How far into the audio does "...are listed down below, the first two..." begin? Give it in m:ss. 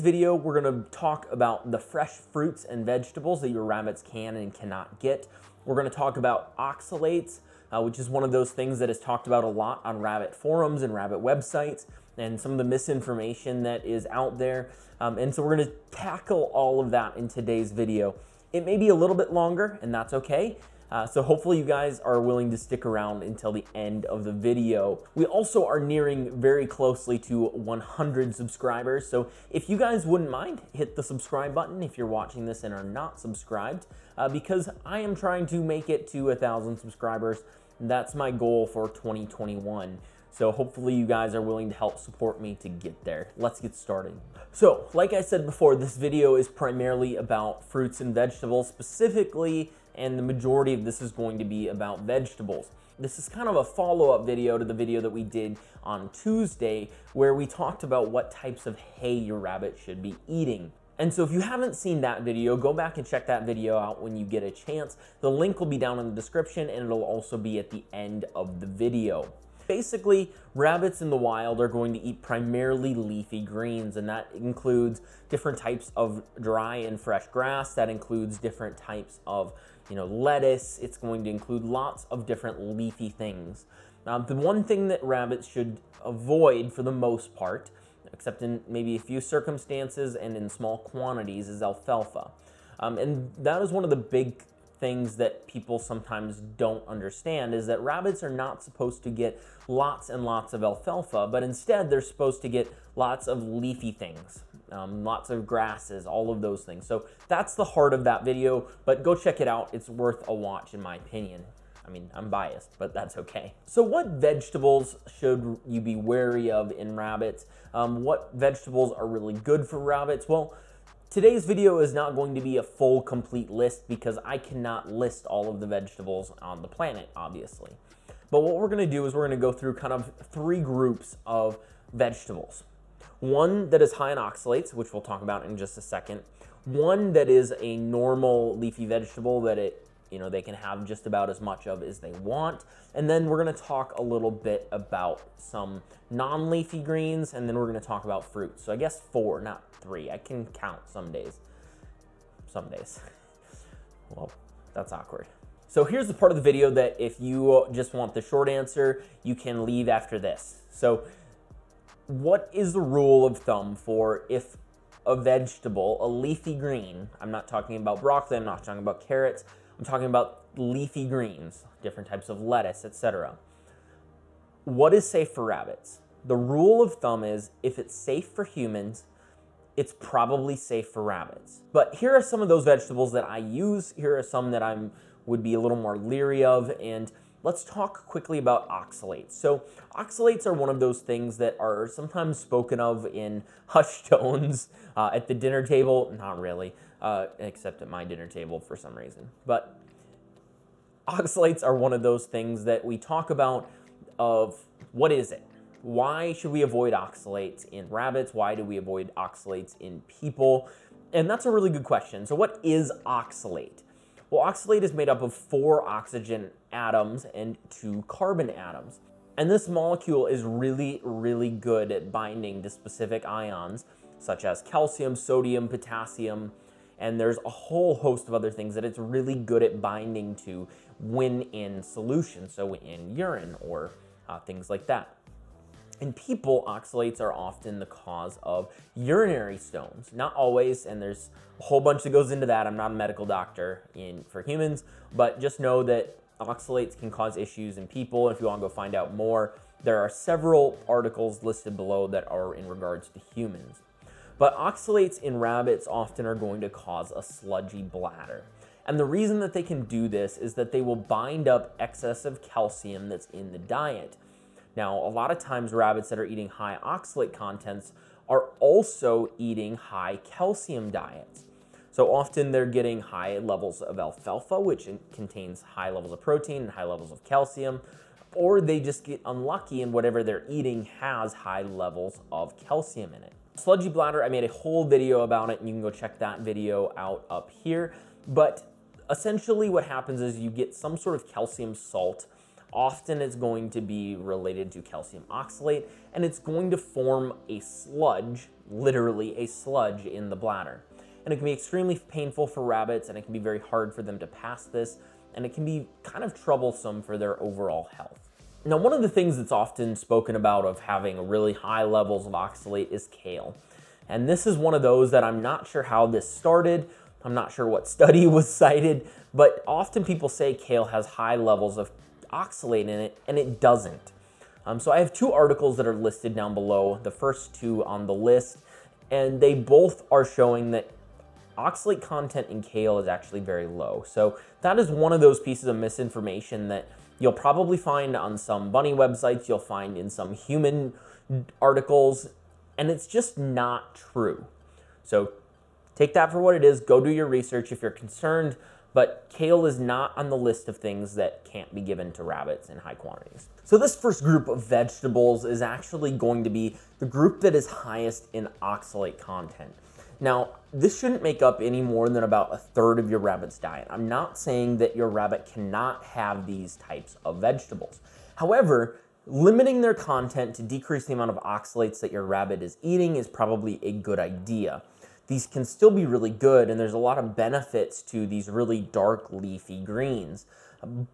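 5:25.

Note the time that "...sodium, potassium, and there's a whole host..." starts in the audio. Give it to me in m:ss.
3:45.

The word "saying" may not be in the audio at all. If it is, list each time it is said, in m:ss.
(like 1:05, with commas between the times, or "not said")
6:04.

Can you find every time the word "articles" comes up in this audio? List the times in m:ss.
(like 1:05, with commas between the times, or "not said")
4:10, 5:25, 5:41.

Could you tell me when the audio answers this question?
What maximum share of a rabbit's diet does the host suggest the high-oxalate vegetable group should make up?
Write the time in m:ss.
6:02.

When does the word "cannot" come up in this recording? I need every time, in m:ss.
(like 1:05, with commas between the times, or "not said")
0:04, 2:04, 6:05.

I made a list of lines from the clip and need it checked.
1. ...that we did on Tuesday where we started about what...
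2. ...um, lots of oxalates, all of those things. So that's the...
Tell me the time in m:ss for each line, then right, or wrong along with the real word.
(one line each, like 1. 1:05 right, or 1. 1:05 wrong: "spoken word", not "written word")
1. 0:55 wrong: "talked", not "started"
2. 1:44 wrong: "grasses", not "oxalates".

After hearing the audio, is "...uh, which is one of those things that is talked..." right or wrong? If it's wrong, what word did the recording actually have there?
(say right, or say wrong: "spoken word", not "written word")
right.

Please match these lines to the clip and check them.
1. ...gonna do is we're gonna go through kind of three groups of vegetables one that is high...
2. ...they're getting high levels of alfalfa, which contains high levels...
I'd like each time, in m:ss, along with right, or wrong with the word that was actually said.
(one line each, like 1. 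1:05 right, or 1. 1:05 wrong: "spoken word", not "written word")
1. 2:08 right
2. 4:32 right.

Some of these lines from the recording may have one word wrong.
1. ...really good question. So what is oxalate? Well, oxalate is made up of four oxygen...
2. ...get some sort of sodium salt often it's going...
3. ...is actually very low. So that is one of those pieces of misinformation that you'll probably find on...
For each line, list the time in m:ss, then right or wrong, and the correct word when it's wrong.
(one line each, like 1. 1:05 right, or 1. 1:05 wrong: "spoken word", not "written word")
1. 3:31 right
2. 4:50 wrong: "calcium", not "sodium"
3. 5:32 right.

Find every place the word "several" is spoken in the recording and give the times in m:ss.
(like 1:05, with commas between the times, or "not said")
4:10.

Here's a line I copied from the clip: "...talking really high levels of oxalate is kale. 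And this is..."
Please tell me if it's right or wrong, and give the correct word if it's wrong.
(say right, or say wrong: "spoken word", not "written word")
wrong: "having", not "talking".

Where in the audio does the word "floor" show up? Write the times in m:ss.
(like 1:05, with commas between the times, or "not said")
not said.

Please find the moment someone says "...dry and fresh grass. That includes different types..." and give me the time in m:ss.
1:16.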